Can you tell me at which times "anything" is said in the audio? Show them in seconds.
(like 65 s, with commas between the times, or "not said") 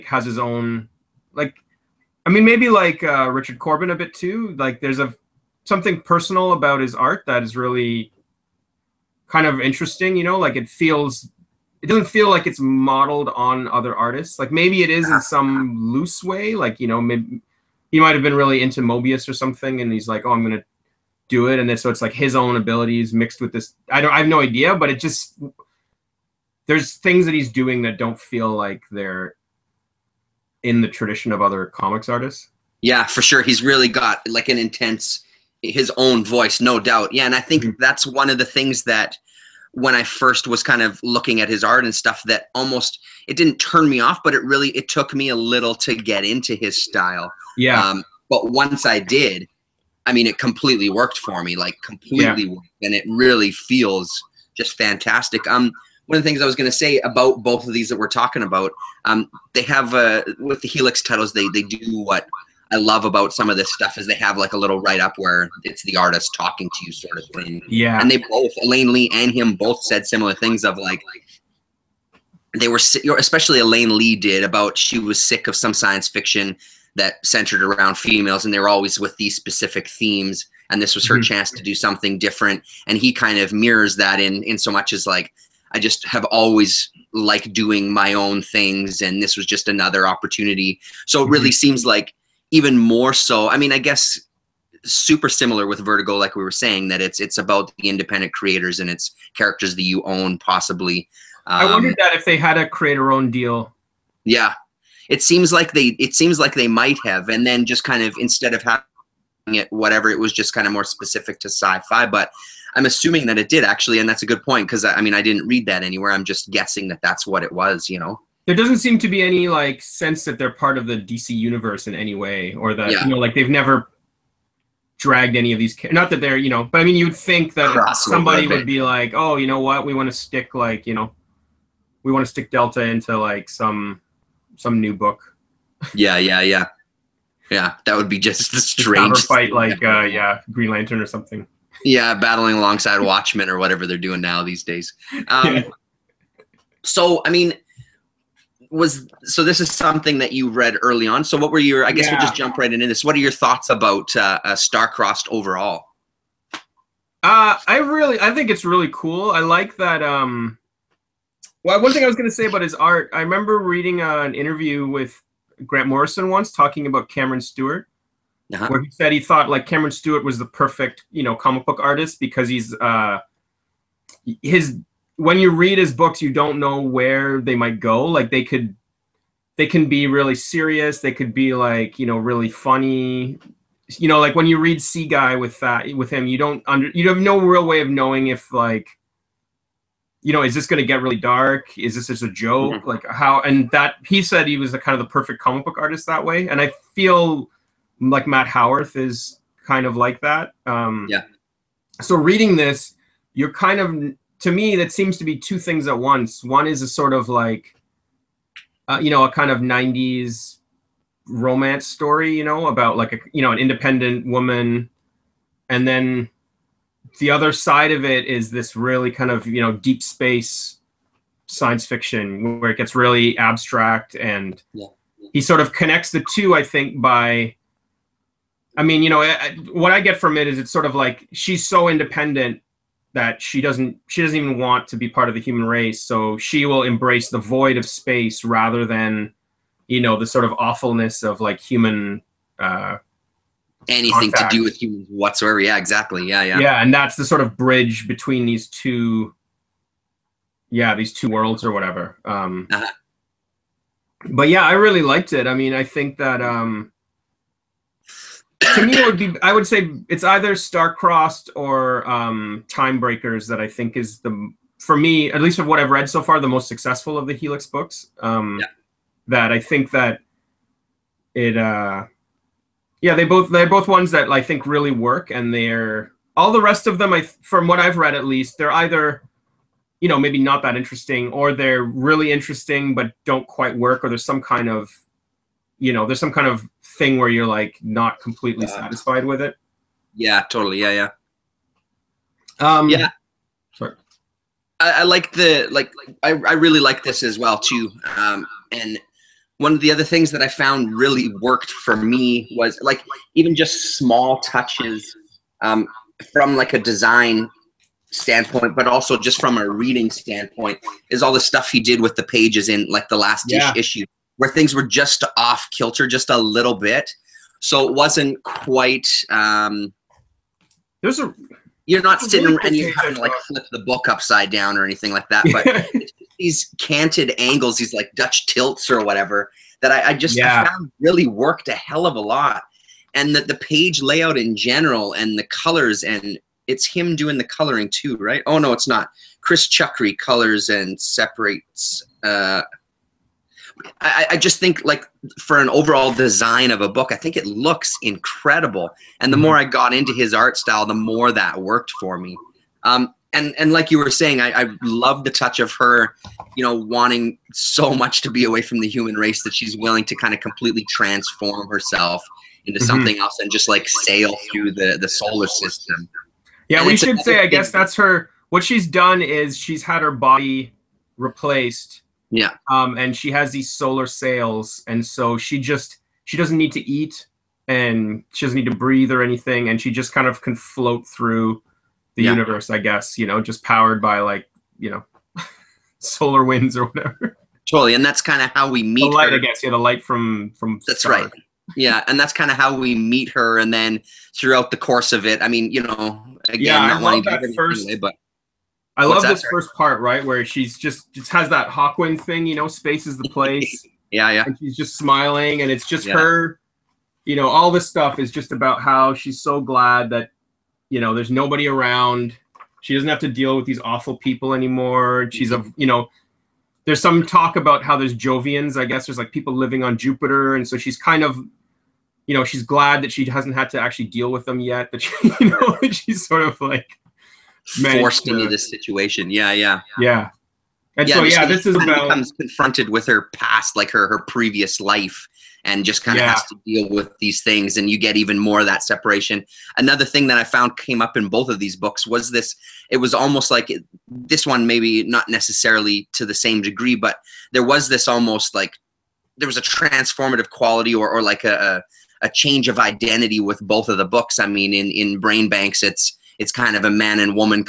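243 s, 324 s, 379 s.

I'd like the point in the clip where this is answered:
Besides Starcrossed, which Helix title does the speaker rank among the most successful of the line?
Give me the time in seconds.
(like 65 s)
262 s.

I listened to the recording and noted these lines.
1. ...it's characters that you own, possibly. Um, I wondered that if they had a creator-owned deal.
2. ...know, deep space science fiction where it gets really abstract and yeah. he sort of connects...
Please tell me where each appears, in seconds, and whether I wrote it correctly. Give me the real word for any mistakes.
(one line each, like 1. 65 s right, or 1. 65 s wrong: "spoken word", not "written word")
1. 98 s right
2. 219 s right.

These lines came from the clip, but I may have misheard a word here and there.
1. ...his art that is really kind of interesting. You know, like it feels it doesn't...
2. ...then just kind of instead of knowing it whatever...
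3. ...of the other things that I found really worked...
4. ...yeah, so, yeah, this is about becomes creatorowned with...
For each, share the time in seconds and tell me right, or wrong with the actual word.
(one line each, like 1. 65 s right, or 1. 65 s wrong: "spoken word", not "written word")
1. 6 s right
2. 107 s wrong: "having", not "knowing"
3. 299 s right
4. 431 s wrong: "confronted", not "creatorowned".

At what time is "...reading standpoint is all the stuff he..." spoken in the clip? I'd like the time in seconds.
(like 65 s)
309 s.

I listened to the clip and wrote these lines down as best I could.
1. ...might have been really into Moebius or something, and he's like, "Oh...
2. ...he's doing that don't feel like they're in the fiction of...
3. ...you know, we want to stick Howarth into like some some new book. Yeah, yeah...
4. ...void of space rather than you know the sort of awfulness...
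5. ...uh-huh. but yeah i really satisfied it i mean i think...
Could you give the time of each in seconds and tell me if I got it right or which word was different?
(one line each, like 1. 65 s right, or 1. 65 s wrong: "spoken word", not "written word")
1. 17 s right
2. 27 s wrong: "tradition", not "fiction"
3. 130 s wrong: "Delta", not "Howarth"
4. 237 s right
5. 252 s wrong: "liked", not "satisfied".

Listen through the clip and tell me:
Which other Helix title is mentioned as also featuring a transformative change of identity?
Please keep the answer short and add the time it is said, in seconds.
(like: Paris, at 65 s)
BrainBanx, at 455 s.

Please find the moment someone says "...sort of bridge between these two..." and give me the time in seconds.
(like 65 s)
247 s.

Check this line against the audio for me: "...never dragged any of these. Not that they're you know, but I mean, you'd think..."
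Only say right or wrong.
right.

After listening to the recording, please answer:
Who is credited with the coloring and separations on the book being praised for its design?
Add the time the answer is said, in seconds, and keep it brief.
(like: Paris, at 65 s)
Chris Chuckry, at 339 s.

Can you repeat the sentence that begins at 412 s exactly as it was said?
She doesn't have to deal with these awful people anymore.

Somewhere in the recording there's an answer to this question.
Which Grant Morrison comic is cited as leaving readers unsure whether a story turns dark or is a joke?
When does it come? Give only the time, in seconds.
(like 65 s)
184 s.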